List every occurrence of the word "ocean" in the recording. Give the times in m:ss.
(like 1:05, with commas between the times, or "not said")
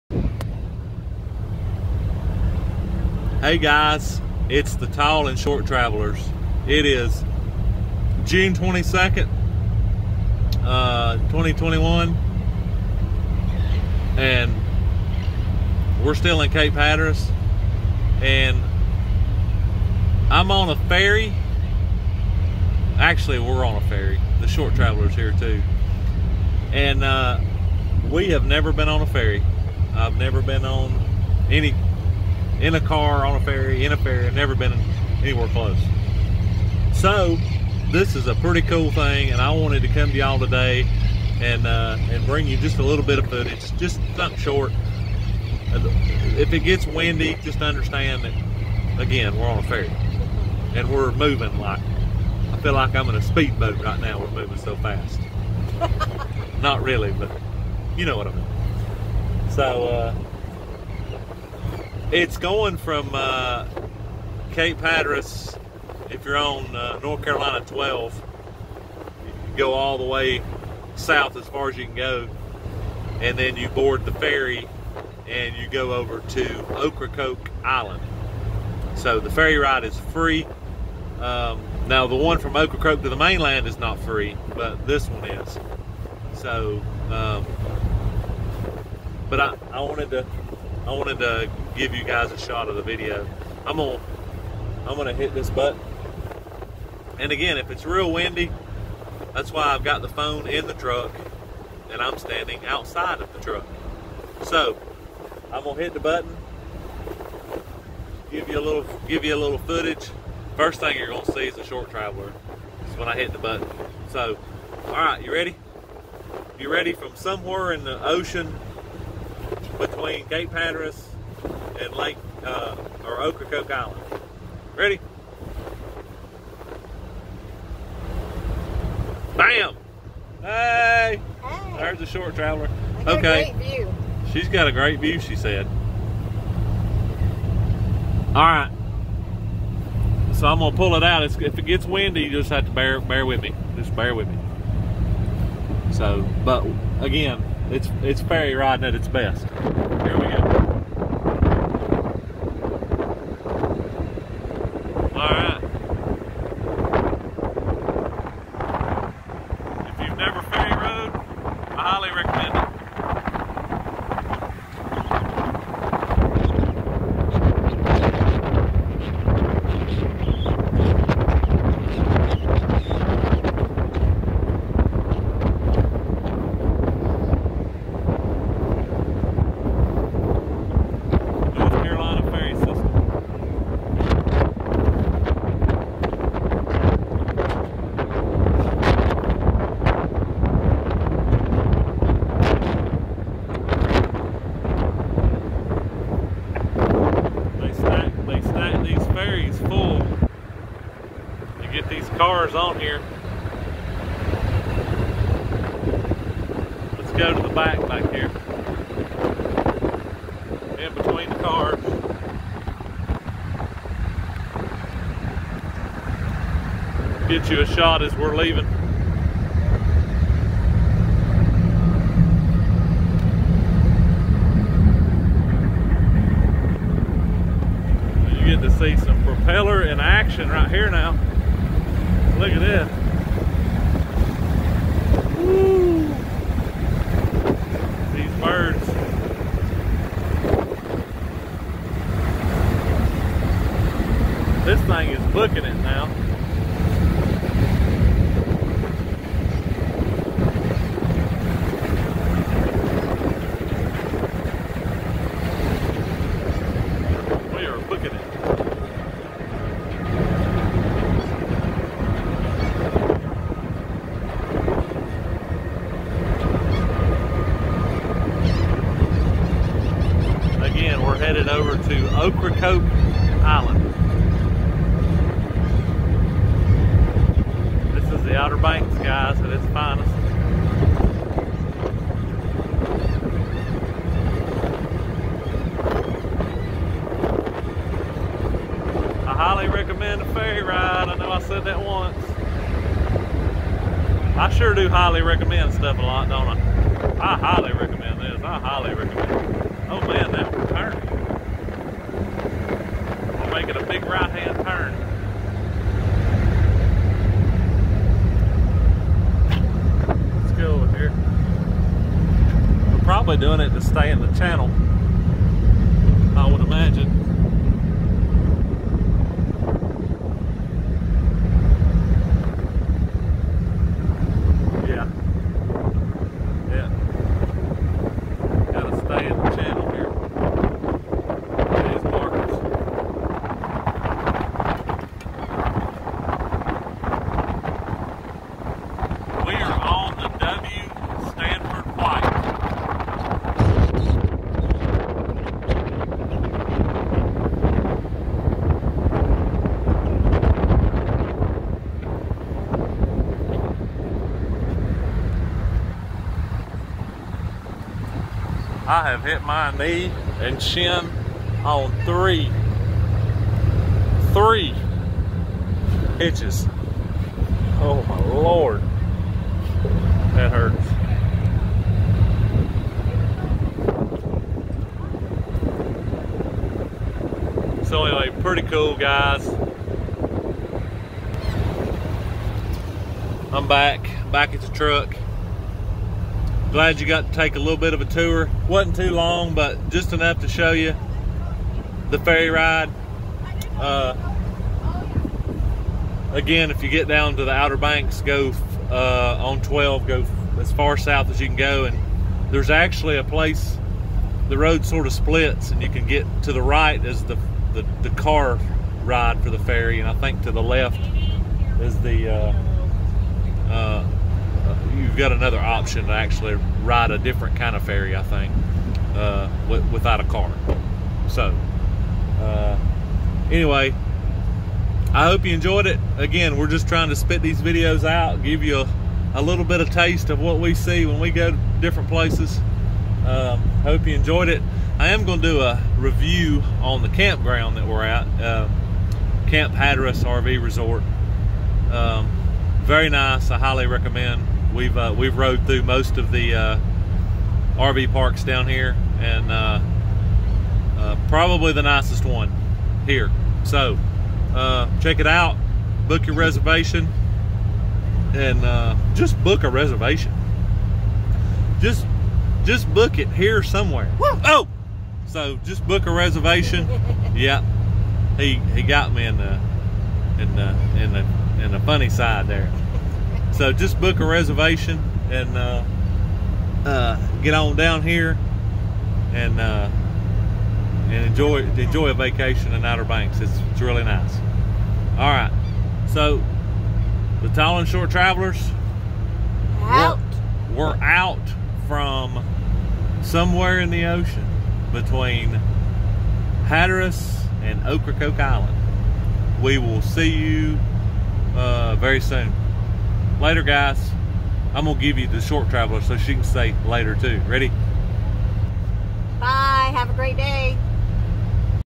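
1:58, 8:14.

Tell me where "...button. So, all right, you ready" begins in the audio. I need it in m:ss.
1:53.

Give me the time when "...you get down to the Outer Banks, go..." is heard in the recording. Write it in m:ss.
6:36.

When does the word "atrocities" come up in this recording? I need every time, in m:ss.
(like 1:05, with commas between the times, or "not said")
not said.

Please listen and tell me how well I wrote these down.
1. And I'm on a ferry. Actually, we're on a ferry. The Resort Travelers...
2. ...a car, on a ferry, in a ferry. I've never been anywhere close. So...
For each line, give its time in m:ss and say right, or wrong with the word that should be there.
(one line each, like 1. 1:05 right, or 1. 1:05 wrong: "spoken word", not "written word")
1. 0:18 wrong: "Short", not "Resort"
2. 0:32 right.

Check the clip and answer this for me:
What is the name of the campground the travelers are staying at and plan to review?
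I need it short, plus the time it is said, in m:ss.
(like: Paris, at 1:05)
Camp Hatteras RV Resort, at 7:19.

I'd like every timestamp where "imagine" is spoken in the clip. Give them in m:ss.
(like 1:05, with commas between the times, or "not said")
5:16.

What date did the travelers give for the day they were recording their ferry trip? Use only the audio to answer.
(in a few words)
June 22nd.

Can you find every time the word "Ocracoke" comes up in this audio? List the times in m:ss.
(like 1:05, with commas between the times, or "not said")
1:16, 1:22, 2:03, 4:32, 8:17.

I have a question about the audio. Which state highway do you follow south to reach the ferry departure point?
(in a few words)
North Carolina 12.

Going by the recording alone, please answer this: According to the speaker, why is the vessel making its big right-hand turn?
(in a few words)
To stay in the channel.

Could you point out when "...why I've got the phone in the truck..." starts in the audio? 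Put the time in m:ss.
1:39.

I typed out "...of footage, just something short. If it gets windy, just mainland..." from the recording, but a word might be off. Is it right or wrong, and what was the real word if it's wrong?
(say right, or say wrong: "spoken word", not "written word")
wrong: "understand", not "mainland".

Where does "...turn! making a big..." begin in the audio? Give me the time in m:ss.
5:00.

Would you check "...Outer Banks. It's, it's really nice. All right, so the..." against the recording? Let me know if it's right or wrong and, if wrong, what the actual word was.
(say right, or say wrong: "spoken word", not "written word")
right.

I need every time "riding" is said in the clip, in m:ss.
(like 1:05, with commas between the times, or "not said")
2:28.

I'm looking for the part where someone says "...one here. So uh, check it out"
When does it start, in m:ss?
7:32.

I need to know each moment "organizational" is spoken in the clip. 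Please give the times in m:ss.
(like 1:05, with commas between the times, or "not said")
not said.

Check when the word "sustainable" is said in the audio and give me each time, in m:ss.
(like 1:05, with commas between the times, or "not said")
not said.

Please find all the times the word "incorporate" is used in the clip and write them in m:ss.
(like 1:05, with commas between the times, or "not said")
not said.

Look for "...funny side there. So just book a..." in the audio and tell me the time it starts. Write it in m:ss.
7:51.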